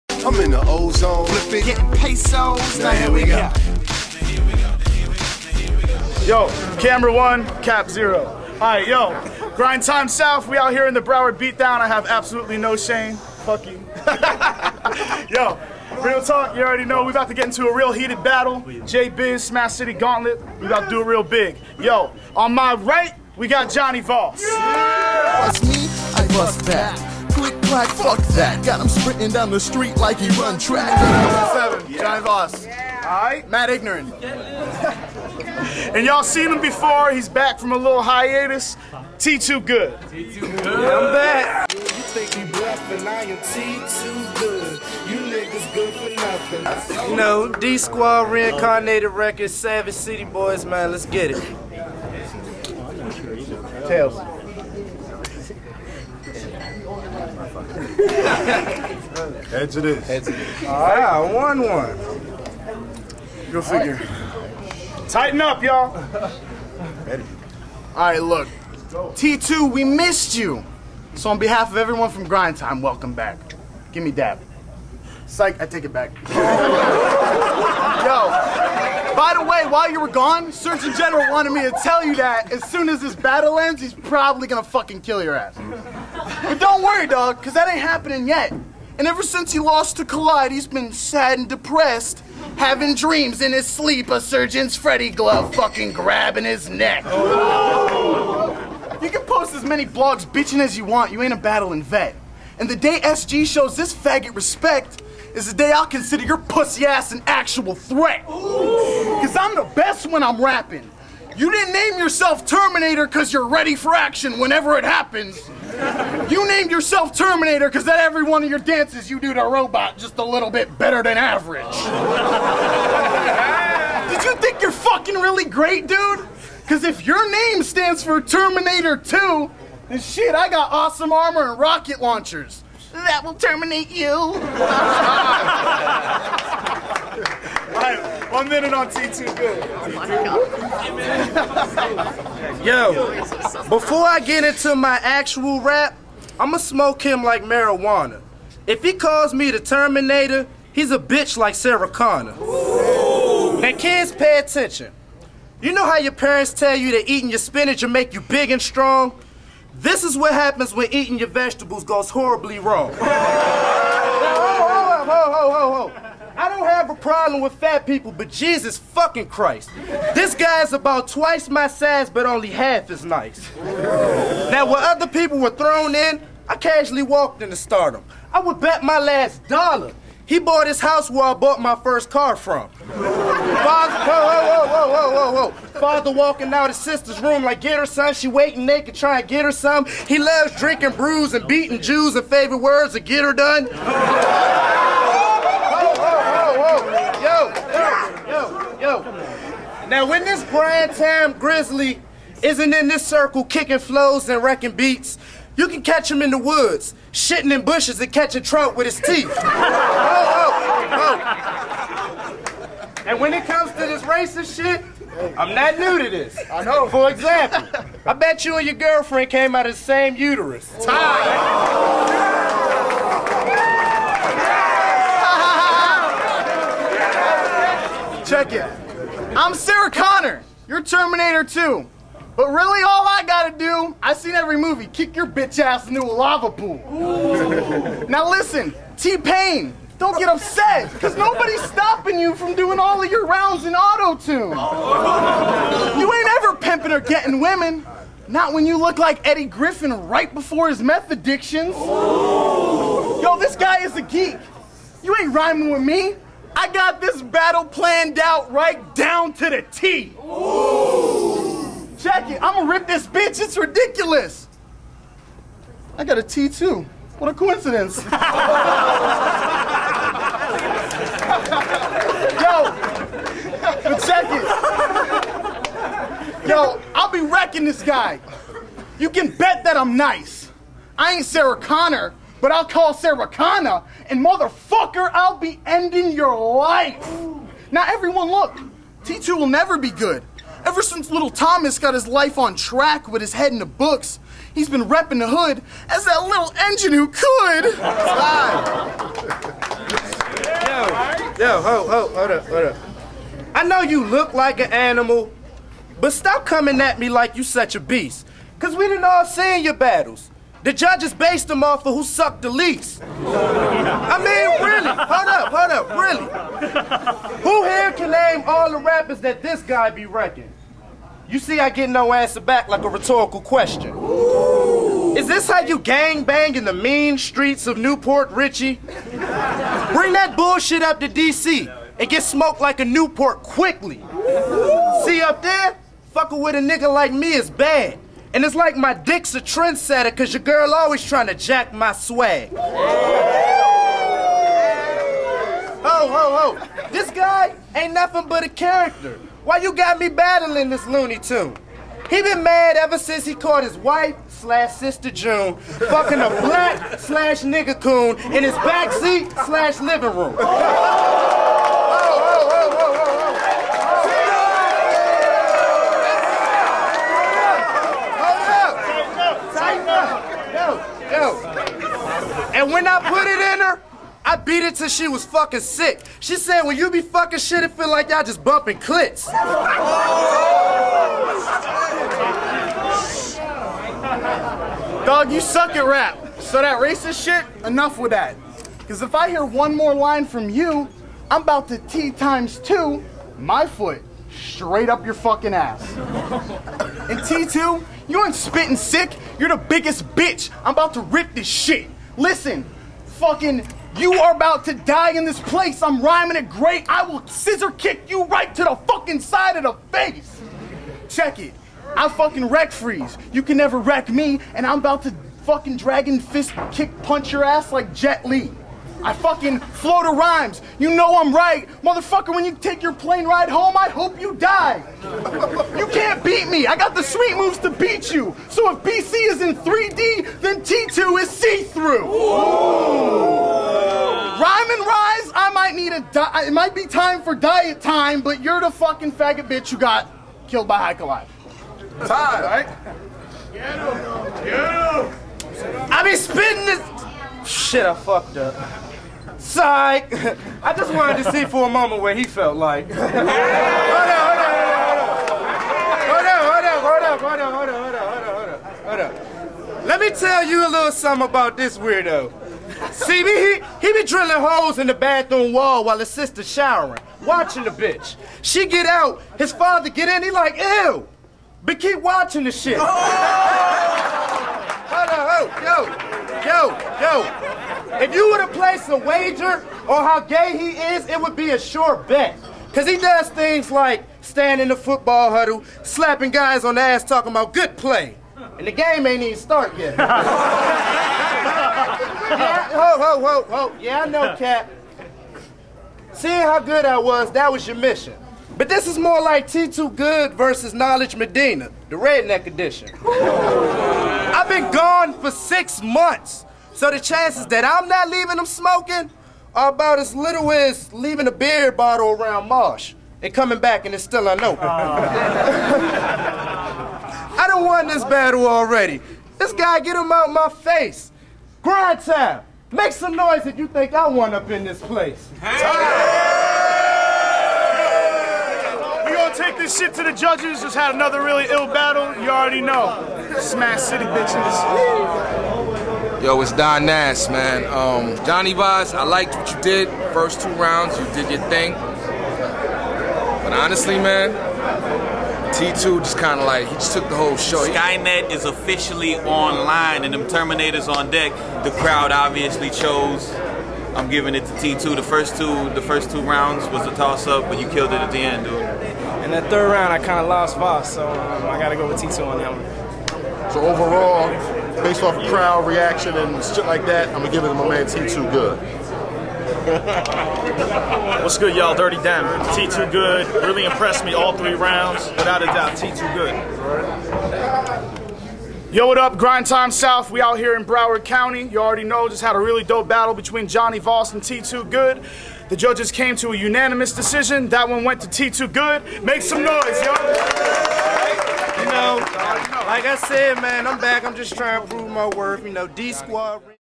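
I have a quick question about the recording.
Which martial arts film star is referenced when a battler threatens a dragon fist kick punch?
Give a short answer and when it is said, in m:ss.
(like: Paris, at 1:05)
Jet Li, at 6:57.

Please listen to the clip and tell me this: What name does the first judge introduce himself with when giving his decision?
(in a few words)
Don Nash.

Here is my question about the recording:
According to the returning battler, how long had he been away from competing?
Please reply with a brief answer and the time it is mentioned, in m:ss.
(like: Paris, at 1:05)
6 months, at 8:25.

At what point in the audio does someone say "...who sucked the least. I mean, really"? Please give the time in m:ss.
5:11.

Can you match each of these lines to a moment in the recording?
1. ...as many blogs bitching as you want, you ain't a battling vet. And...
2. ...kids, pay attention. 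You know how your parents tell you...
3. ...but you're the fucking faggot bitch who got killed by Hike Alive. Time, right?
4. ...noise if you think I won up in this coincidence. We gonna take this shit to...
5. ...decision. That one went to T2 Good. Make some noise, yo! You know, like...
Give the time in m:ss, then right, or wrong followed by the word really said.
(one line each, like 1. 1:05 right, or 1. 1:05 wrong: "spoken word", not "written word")
1. 1:39 right
2. 2:33 right
3. 7:18 right
4. 8:43 wrong: "place", not "coincidence"
5. 9:46 right.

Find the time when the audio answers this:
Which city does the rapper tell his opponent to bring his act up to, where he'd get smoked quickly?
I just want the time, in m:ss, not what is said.
5:31.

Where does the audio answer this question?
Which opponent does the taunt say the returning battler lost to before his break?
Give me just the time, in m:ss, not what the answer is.
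1:30.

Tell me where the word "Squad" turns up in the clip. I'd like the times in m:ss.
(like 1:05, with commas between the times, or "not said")
0:47, 9:55.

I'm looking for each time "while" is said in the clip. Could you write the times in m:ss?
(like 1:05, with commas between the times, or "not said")
1:19, 7:45.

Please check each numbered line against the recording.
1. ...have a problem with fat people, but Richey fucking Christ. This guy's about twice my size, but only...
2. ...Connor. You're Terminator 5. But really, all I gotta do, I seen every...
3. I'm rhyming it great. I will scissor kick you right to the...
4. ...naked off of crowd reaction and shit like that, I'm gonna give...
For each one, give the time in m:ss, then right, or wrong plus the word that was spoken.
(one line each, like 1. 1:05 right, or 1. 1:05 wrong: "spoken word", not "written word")
1. 2:46 wrong: "Jesus", not "Richey"
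2. 3:49 wrong: "2", not "5"
3. 6:45 right
4. 9:24 wrong: "based", not "naked".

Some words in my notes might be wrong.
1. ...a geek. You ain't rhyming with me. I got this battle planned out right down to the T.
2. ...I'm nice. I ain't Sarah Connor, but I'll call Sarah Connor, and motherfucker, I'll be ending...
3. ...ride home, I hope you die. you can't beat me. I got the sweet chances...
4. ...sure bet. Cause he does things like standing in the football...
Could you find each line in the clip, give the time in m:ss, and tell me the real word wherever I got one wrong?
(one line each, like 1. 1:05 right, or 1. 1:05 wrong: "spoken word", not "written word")
1. 4:13 right
2. 4:39 right
3. 7:03 wrong: "moves", not "chances"
4. 8:01 right.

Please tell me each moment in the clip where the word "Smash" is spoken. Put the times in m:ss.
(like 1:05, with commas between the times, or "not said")
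0:19, 8:53.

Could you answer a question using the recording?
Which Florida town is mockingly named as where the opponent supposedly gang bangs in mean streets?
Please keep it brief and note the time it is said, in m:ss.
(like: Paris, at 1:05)
New Port Richey, at 5:27.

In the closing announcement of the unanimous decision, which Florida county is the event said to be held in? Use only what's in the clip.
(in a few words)
Broward County.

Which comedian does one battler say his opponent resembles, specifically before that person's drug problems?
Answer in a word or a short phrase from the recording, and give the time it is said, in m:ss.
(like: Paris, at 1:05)
Eddie Griffin, at 4:09.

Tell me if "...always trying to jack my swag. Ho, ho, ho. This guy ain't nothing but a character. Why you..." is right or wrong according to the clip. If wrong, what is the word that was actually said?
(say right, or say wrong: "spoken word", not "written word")
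right.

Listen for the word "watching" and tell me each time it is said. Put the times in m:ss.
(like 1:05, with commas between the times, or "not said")
7:47, 7:51.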